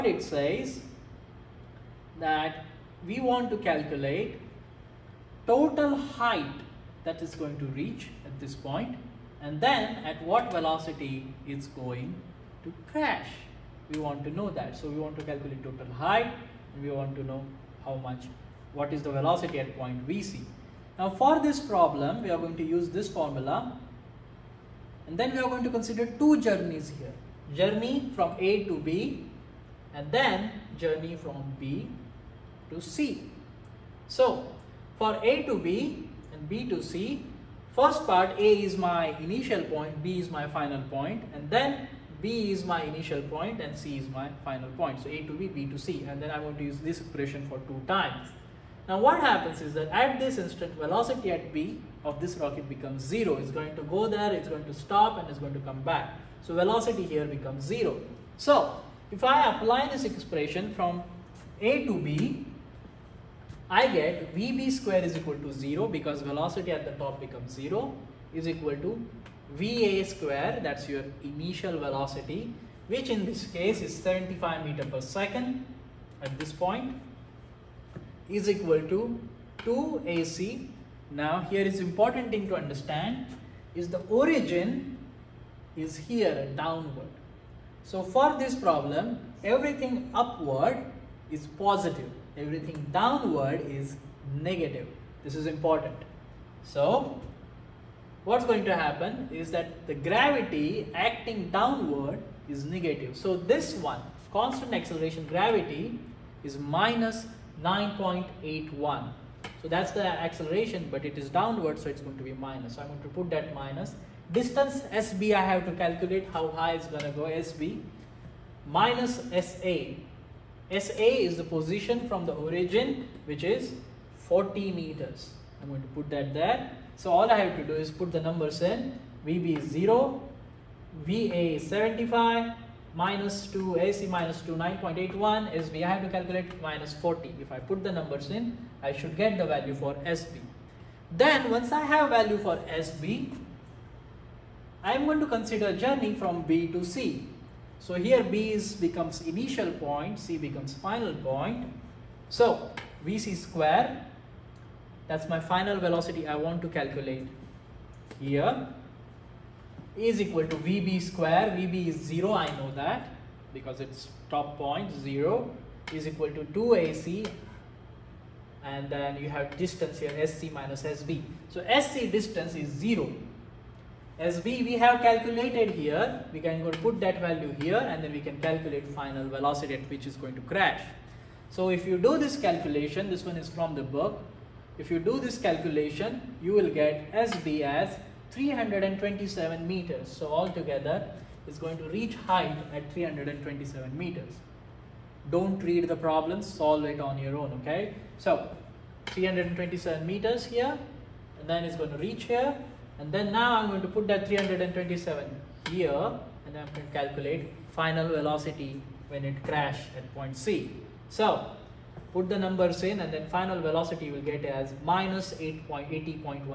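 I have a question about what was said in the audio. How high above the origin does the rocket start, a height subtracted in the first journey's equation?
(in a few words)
40 meters.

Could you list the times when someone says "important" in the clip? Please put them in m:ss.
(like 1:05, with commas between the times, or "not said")
1:21, 1:35.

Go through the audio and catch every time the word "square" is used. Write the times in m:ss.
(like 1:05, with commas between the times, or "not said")
1:04, 1:10, 2:33, 2:41.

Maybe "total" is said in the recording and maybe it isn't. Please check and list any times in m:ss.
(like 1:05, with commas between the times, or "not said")
0:05, 0:15.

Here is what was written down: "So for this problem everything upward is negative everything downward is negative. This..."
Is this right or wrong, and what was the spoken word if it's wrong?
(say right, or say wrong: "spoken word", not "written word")
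wrong: "positive", not "negative".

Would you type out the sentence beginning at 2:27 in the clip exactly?
So here B is becomes initial point, C becomes final point.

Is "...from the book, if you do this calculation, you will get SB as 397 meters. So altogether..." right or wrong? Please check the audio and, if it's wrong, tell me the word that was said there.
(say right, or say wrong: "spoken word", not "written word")
wrong: "327", not "397".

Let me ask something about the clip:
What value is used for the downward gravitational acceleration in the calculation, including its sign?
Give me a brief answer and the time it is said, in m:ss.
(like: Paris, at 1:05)
-9.81, at 1:46.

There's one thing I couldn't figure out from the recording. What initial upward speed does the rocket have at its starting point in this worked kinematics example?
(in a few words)
75 meters per second.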